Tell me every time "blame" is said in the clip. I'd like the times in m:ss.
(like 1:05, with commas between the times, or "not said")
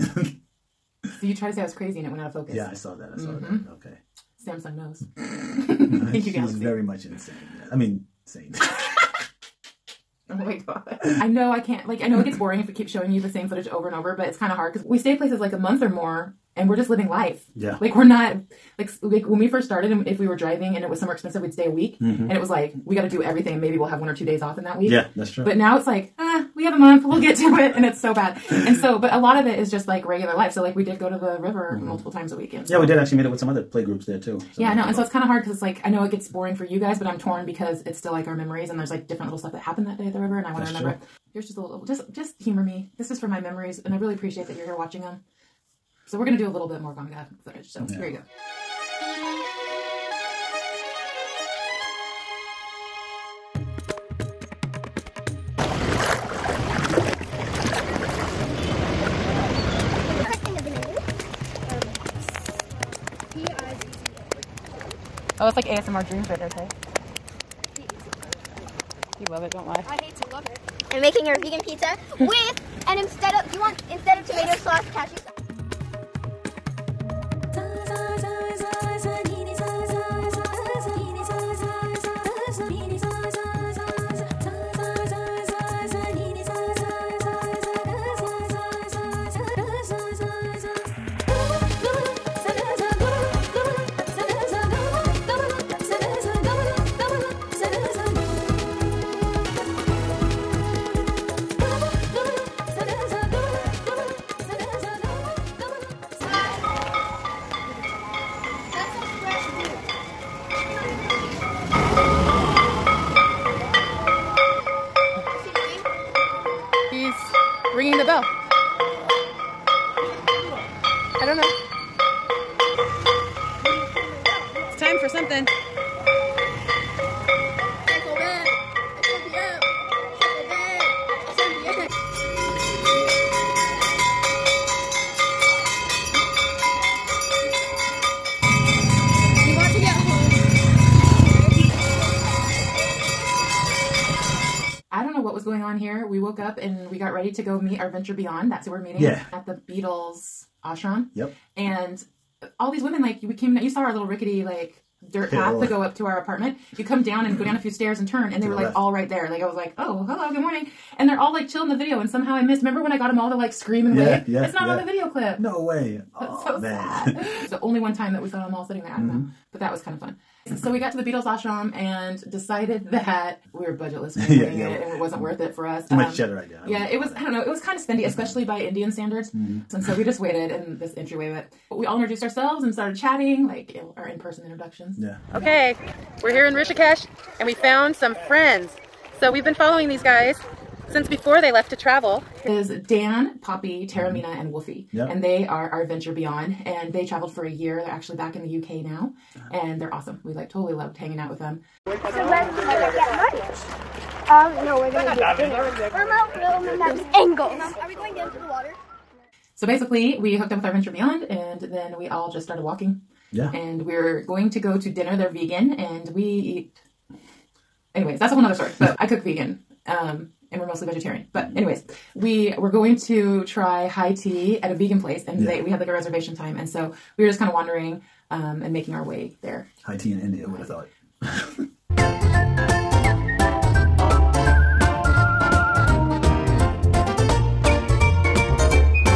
not said.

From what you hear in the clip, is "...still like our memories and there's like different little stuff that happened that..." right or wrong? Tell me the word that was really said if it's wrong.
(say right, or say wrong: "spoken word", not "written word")
right.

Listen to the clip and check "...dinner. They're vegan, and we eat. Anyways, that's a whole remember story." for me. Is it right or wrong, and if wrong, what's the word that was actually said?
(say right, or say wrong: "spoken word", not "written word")
wrong: "nother", not "remember".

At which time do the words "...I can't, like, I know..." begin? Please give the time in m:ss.
0:11.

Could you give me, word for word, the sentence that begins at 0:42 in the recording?
This is for my memories and I really appreciate that you're here watching them.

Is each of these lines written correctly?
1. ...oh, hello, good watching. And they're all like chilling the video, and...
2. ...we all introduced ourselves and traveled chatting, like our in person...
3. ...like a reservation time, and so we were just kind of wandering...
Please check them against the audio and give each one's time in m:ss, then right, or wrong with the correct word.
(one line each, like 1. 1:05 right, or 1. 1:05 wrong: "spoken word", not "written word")
1. 2:39 wrong: "morning", not "watching"
2. 3:01 wrong: "started", not "traveled"
3. 3:45 right.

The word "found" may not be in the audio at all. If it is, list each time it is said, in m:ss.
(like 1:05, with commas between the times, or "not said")
3:07.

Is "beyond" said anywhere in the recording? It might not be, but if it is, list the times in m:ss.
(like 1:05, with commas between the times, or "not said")
2:28, 3:16, 3:30.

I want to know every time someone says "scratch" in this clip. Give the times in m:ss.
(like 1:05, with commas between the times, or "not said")
not said.